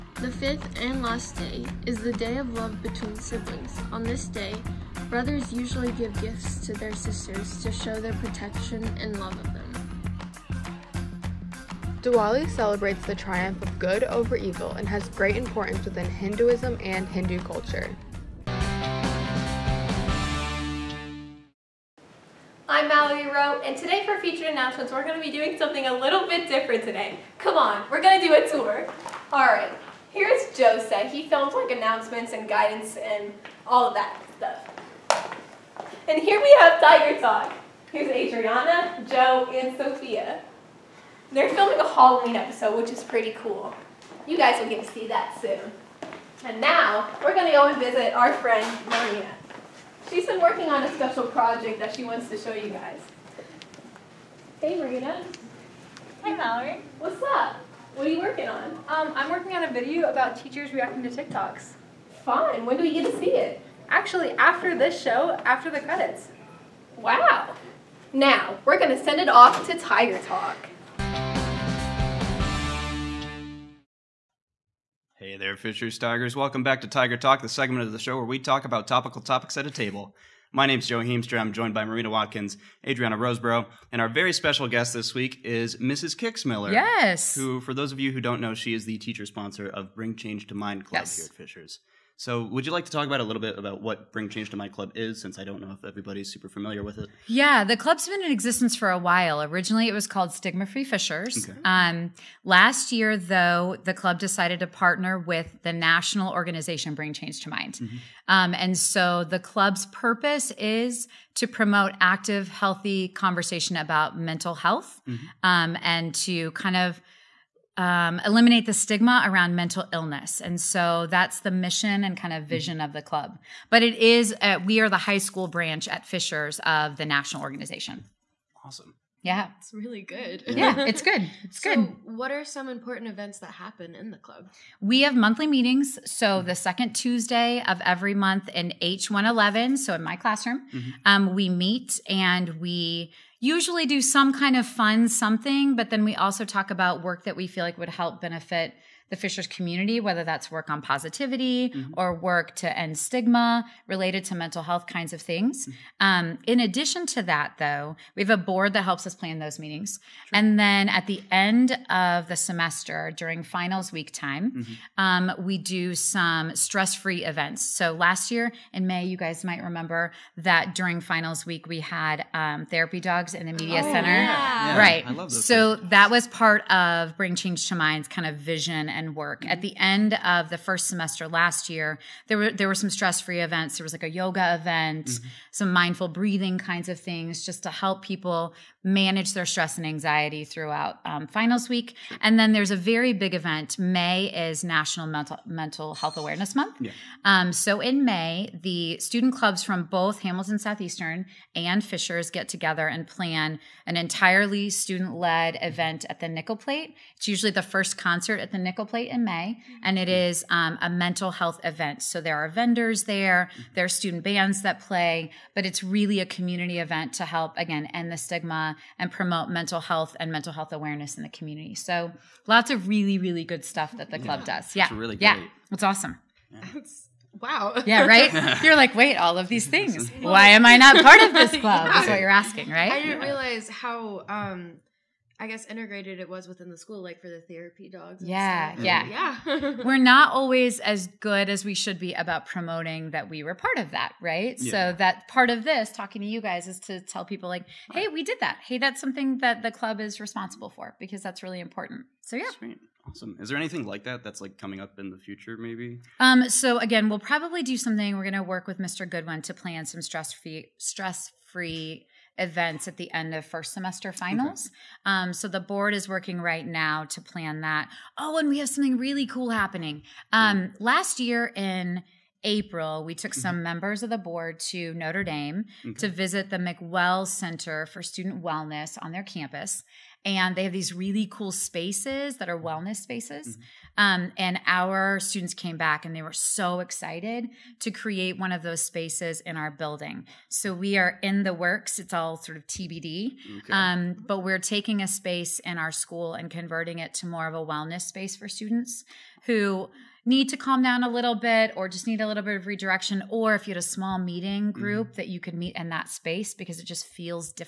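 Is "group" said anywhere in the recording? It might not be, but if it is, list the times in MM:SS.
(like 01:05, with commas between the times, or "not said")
05:04.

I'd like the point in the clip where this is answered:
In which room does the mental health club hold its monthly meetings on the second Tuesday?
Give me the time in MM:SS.
02:18.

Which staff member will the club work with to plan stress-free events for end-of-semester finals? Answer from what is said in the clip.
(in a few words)
Mr. Goodwin.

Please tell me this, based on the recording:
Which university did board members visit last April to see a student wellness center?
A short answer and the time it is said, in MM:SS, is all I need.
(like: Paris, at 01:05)
Notre Dame, at 04:34.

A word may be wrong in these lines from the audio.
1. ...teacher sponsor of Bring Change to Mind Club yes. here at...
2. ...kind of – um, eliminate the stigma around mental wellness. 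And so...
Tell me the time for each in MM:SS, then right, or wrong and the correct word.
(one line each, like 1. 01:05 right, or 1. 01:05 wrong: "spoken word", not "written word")
1. 01:28 right
2. 01:56 wrong: "illness", not "wellness".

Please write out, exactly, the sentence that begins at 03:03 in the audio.
There was like a yoga event, mm-hmm.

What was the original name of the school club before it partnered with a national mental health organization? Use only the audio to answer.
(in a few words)
Stigma Free Fishers.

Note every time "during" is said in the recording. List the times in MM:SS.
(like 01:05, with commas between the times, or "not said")
02:43, 02:50.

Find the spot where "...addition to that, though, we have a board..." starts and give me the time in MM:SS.
02:36.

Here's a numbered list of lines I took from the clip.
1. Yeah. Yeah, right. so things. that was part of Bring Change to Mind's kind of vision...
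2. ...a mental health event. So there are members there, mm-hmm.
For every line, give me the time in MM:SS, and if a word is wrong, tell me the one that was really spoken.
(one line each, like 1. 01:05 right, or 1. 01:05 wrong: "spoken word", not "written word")
1. 02:54 right
2. 03:30 wrong: "vendors", not "members".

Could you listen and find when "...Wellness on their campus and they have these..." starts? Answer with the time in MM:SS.
04:38.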